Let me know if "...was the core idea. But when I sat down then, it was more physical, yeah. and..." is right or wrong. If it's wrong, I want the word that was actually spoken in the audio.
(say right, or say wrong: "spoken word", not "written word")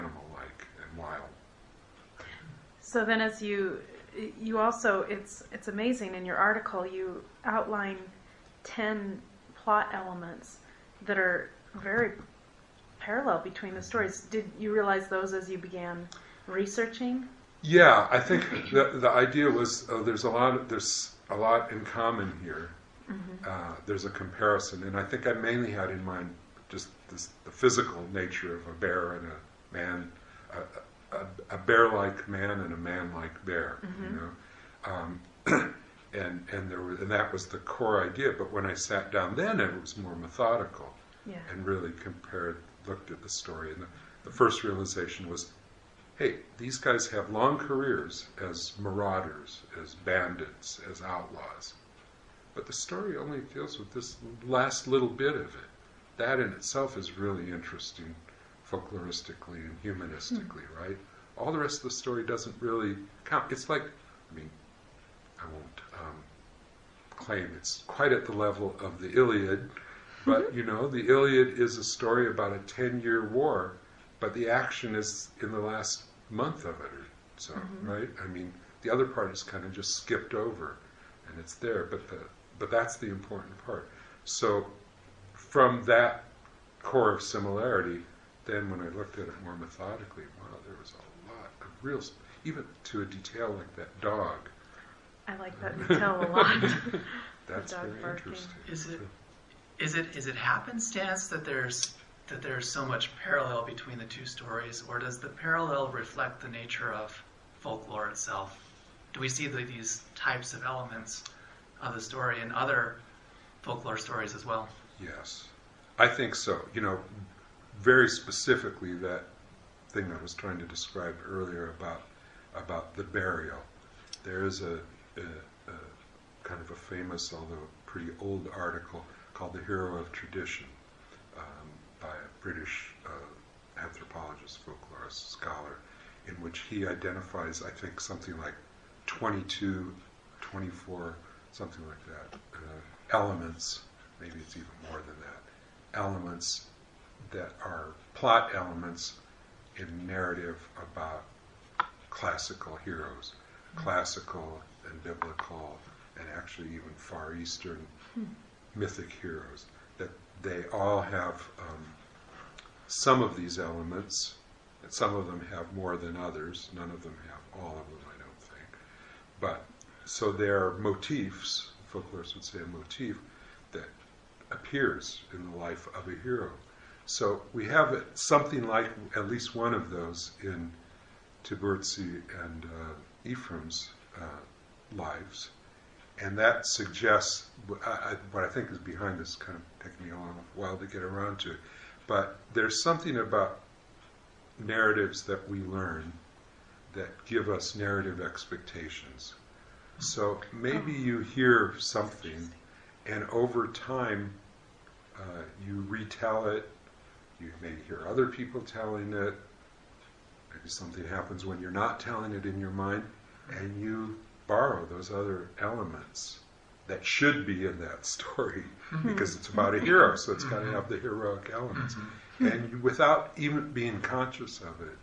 wrong: "methodical", not "physical".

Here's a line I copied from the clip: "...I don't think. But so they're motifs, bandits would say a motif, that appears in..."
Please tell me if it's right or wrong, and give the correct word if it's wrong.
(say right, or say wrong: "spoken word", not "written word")
wrong: "folklorists", not "bandits".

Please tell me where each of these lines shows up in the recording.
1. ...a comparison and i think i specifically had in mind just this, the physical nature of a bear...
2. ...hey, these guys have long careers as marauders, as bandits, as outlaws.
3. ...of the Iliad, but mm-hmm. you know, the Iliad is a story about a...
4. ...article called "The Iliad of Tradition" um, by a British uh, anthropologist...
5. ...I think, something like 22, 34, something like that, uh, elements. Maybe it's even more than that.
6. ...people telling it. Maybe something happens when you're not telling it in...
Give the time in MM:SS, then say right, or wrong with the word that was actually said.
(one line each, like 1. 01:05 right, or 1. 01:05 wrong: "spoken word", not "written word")
1. 00:24 wrong: "mainly", not "specifically"
2. 00:46 right
3. 01:08 right
4. 02:08 wrong: "Hero", not "Iliad"
5. 02:17 wrong: "24", not "34"
6. 03:28 right.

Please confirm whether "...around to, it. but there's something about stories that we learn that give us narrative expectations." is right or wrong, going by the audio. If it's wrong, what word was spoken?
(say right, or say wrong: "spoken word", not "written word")
wrong: "narratives", not "stories".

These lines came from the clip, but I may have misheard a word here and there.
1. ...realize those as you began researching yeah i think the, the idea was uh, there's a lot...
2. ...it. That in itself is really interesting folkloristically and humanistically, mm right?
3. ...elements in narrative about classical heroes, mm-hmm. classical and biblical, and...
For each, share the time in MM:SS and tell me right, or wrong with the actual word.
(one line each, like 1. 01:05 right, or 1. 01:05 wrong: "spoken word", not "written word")
1. 00:14 right
2. 00:55 right
3. 02:28 right.